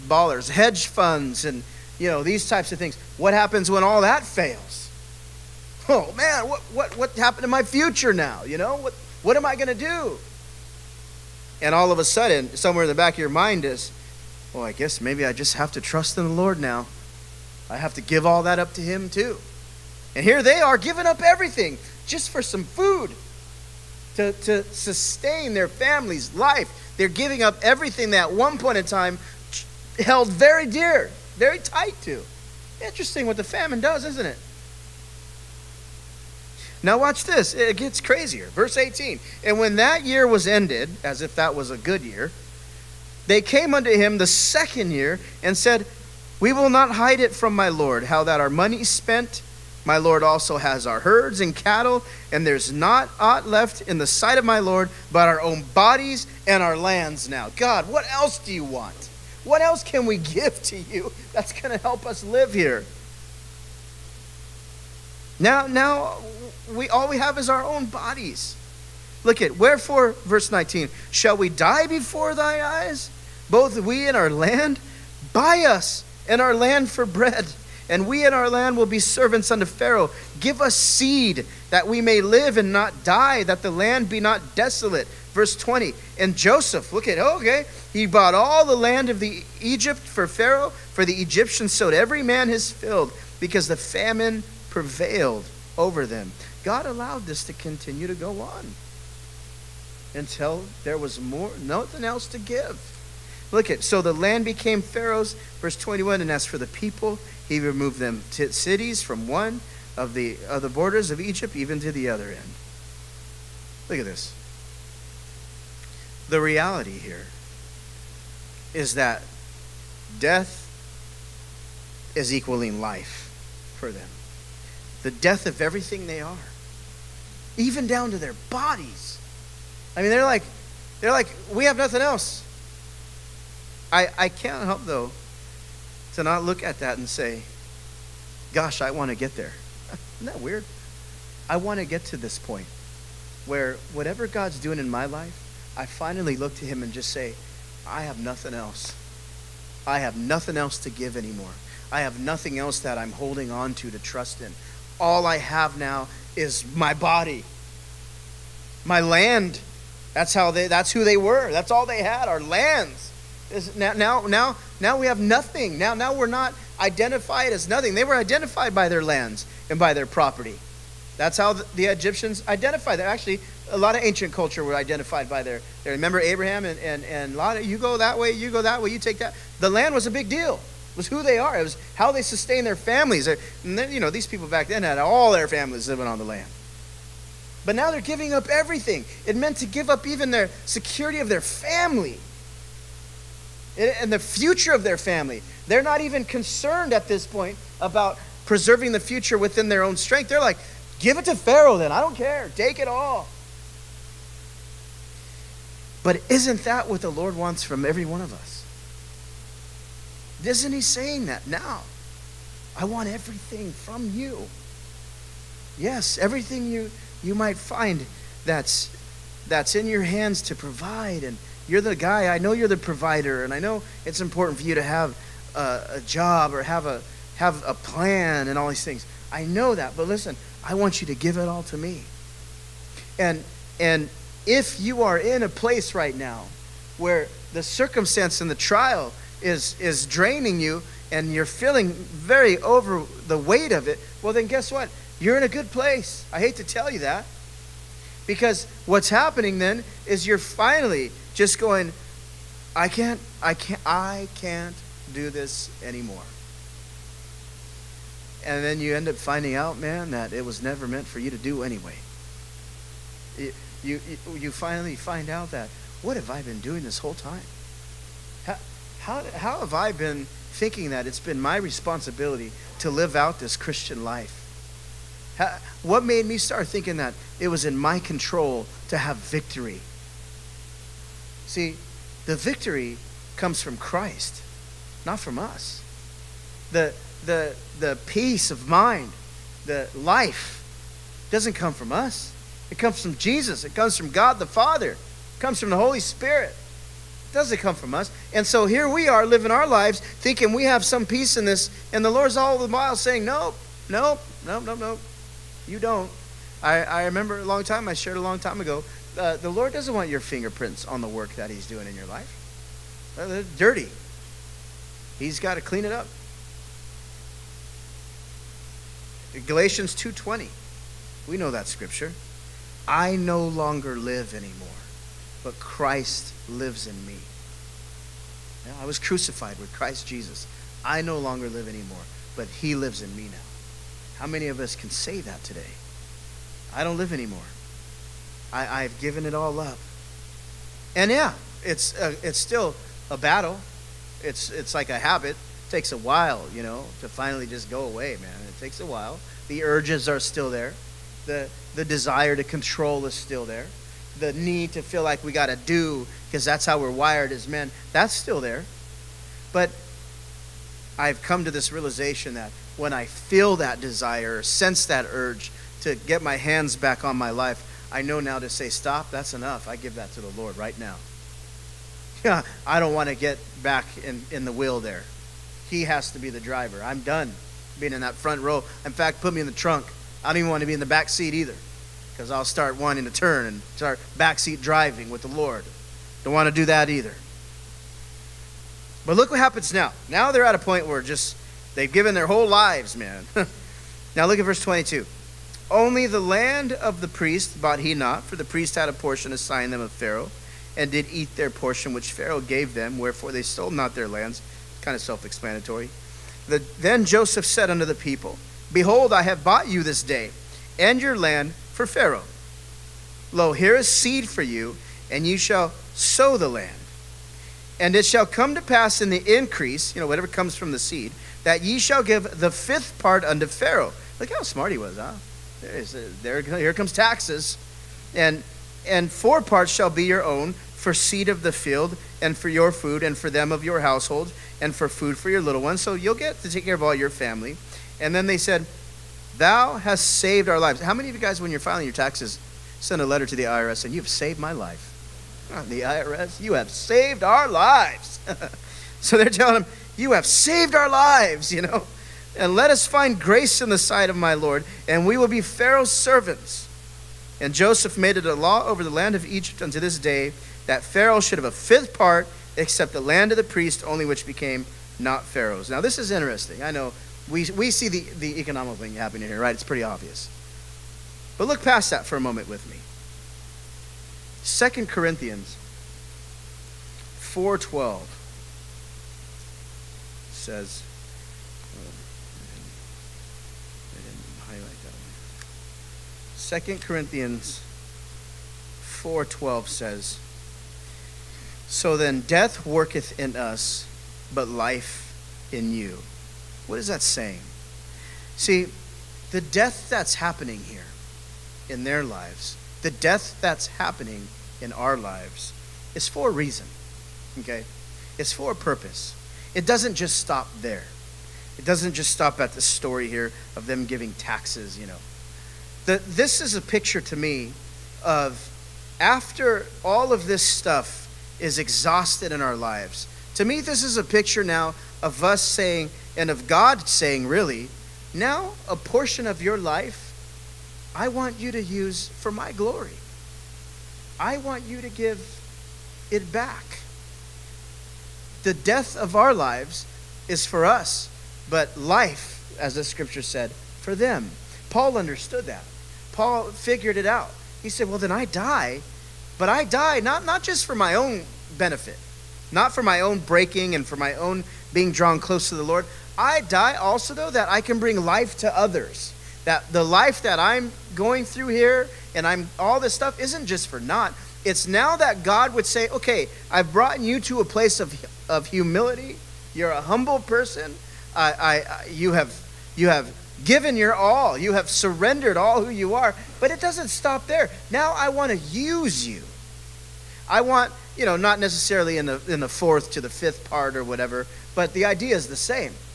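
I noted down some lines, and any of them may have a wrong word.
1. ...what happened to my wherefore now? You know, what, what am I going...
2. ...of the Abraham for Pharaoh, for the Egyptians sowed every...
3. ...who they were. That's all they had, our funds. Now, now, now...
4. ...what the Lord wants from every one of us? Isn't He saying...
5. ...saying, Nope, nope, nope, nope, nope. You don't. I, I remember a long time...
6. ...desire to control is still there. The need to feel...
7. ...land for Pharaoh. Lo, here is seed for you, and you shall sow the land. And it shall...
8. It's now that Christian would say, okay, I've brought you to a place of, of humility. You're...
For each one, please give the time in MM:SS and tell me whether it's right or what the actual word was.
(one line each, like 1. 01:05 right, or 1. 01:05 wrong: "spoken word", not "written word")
1. 00:06 wrong: "future", not "wherefore"
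2. 01:29 wrong: "Egypt", not "Abraham"
3. 02:40 wrong: "lands", not "funds"
4. 03:26 right
5. 05:02 right
6. 05:51 right
7. 06:51 right
8. 09:24 wrong: "God", not "Christian".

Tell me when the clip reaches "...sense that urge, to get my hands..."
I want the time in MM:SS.
06:04.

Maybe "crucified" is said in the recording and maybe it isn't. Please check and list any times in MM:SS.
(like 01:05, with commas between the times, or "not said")
05:28.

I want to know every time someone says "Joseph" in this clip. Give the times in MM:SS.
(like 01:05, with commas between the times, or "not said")
01:26, 06:47, 07:37.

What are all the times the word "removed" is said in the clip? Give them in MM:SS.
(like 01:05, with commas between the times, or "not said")
01:47.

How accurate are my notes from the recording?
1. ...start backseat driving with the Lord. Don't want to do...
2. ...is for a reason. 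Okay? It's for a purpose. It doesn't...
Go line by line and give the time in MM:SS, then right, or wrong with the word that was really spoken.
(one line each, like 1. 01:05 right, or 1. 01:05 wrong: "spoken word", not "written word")
1. 06:23 right
2. 08:25 right.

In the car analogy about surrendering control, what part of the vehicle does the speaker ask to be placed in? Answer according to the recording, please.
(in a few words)
The trunk.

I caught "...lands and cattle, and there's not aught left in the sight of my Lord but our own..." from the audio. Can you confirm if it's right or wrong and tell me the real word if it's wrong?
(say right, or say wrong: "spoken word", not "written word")
wrong: "herds", not "lands".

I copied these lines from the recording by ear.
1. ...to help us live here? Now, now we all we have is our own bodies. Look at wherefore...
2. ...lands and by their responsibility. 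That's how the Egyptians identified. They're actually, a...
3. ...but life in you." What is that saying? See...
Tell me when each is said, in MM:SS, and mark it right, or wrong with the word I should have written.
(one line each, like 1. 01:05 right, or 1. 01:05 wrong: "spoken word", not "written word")
1. 01:01 right
2. 02:49 wrong: "property", not "responsibility"
3. 08:14 right.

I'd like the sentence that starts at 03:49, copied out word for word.
I know that, but listen, I want you to give it all to me.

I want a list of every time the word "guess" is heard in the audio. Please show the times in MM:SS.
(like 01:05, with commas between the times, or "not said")
00:14, 04:04.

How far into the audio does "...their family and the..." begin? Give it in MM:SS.
03:11.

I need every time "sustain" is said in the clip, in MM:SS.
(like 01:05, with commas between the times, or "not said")
00:24, 03:02.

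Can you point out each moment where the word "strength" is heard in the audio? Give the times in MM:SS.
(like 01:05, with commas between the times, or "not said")
03:19.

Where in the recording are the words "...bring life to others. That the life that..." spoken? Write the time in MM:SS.
09:17.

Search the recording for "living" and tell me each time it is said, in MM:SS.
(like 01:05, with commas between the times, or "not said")
03:05, 04:59.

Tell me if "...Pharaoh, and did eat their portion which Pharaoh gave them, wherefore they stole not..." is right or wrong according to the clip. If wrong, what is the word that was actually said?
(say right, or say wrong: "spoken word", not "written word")
right.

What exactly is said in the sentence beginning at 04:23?
You, you, you finally find out that, what have I been doing this whole time?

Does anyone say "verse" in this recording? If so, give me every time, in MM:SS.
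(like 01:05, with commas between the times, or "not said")
00:38, 01:10, 01:25, 01:45, 06:34.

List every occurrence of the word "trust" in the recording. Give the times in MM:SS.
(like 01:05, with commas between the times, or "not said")
00:15, 02:33.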